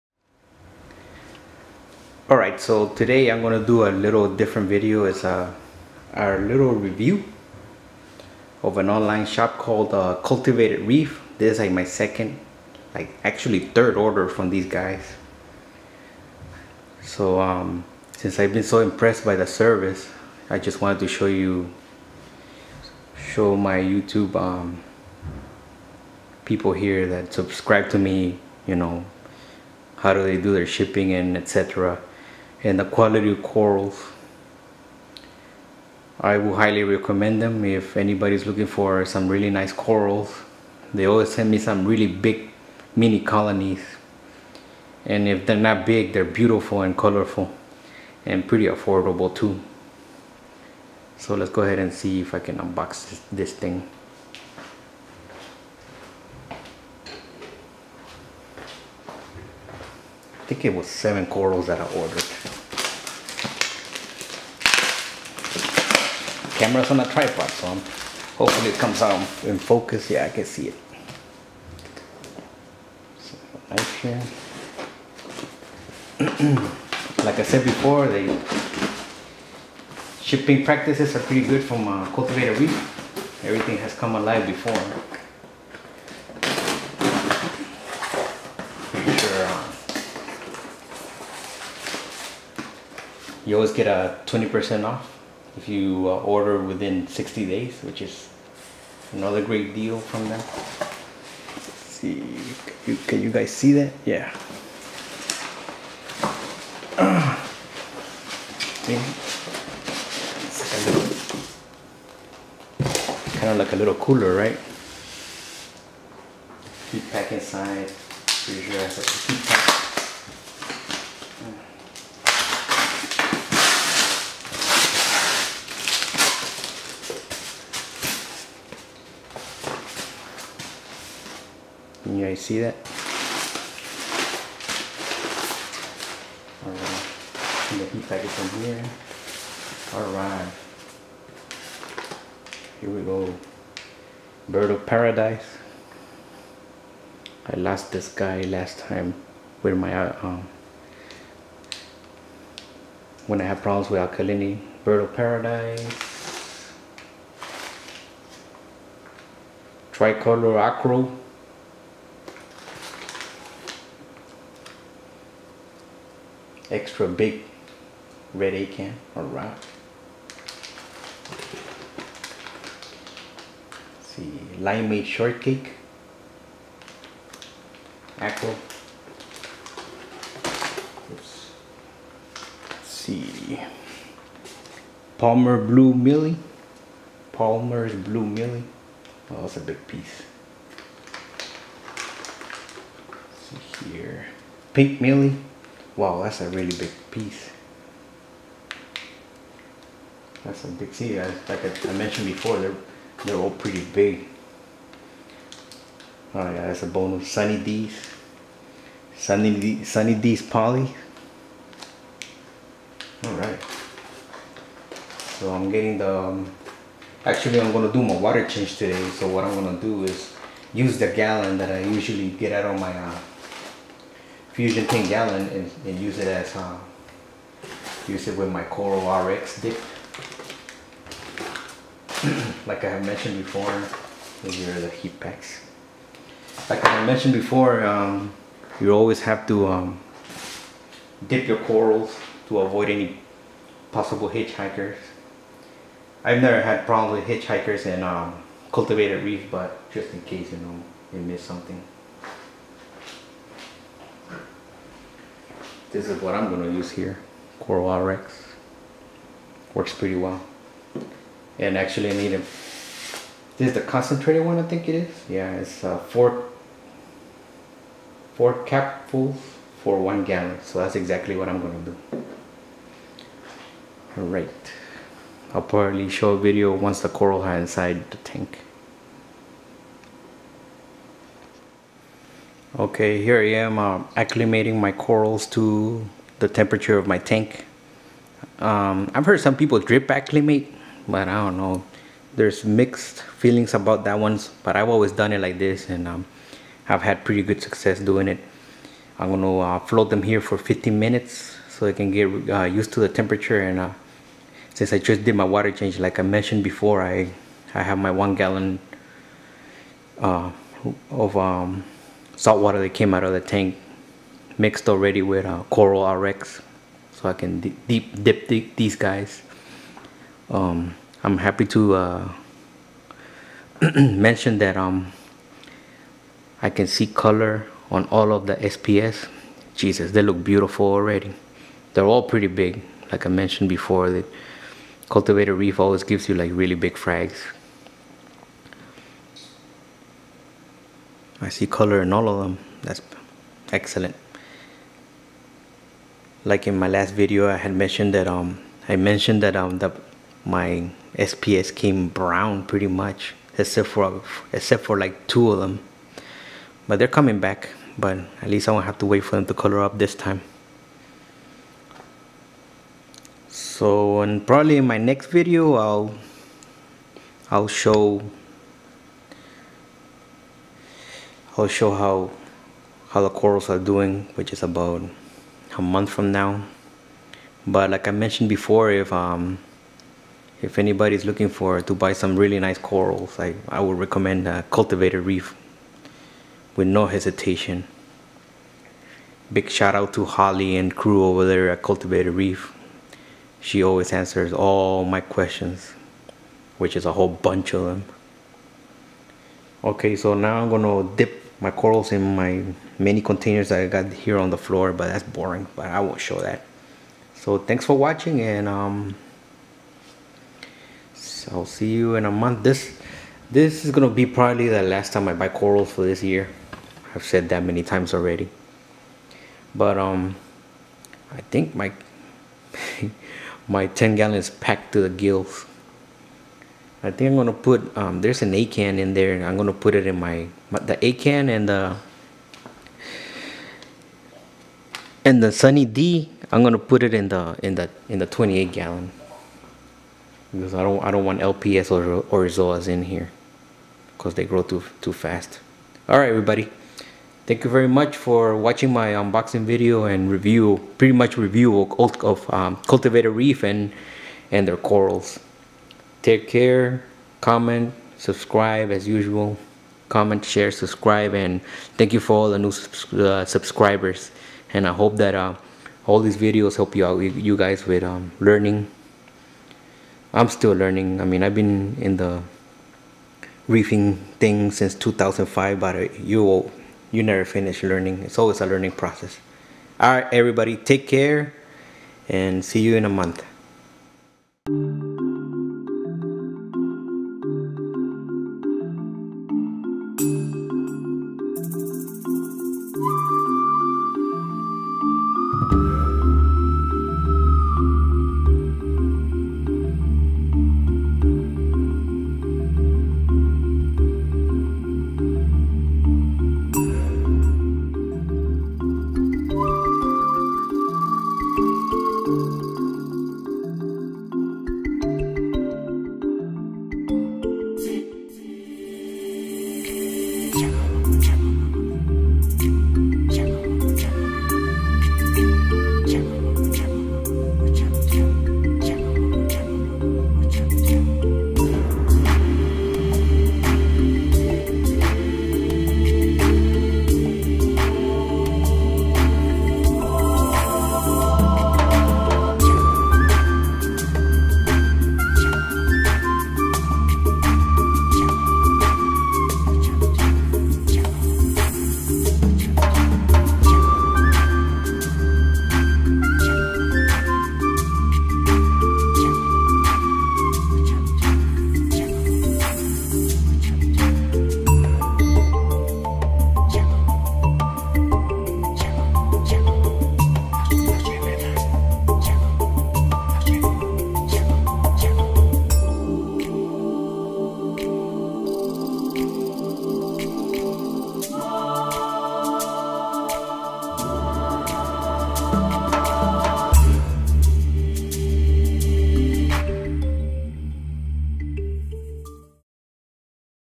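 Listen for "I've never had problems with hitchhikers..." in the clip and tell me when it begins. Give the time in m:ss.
4:06.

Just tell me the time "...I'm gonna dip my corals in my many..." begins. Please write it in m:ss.
6:40.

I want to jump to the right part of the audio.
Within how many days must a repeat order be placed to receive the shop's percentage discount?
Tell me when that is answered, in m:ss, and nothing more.
1:37.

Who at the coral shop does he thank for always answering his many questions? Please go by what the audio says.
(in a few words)
Holly.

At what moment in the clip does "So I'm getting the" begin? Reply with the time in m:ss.
3:35.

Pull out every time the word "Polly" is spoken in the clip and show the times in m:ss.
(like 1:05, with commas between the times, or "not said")
3:30.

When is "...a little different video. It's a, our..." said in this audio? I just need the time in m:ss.
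0:03.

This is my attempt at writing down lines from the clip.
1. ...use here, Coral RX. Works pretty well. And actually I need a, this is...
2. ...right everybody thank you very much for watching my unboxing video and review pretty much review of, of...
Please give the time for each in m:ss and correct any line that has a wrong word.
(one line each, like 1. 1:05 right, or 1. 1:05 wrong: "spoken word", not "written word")
1. 4:16 right
2. 7:26 right.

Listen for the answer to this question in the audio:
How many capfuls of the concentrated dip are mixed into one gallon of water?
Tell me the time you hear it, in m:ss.
4:28.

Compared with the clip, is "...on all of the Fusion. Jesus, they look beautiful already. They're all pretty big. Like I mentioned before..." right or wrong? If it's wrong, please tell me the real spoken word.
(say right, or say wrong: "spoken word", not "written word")
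wrong: "SPS", not "Fusion".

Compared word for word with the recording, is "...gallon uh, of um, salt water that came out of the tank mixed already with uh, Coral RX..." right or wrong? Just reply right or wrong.
right.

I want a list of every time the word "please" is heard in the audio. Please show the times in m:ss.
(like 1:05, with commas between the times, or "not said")
not said.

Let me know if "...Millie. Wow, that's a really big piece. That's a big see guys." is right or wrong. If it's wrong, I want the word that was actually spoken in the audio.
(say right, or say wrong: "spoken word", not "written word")
right.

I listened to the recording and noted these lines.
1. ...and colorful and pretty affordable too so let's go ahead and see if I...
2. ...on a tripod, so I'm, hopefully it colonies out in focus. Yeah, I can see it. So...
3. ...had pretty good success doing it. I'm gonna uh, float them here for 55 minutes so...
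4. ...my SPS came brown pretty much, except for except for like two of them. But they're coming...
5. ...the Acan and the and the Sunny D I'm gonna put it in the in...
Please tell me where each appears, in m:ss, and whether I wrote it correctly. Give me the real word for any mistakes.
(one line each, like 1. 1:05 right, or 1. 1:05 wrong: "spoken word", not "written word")
1. 0:46 right
2. 1:06 wrong: "comes", not "colonies"
3. 4:57 wrong: "15", not "55"
4. 5:50 right
5. 7:10 right.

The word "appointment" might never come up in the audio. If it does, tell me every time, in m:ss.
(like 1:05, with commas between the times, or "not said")
not said.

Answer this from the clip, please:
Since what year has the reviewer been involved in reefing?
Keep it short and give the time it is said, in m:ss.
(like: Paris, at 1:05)
2005, at 7:54.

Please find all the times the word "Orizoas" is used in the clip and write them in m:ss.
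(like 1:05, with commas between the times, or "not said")
7:22.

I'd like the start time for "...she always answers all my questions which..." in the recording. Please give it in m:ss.
6:33.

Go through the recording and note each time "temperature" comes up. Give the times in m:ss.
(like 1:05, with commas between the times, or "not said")
4:46, 5:03.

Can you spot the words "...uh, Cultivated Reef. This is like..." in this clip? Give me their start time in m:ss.
0:09.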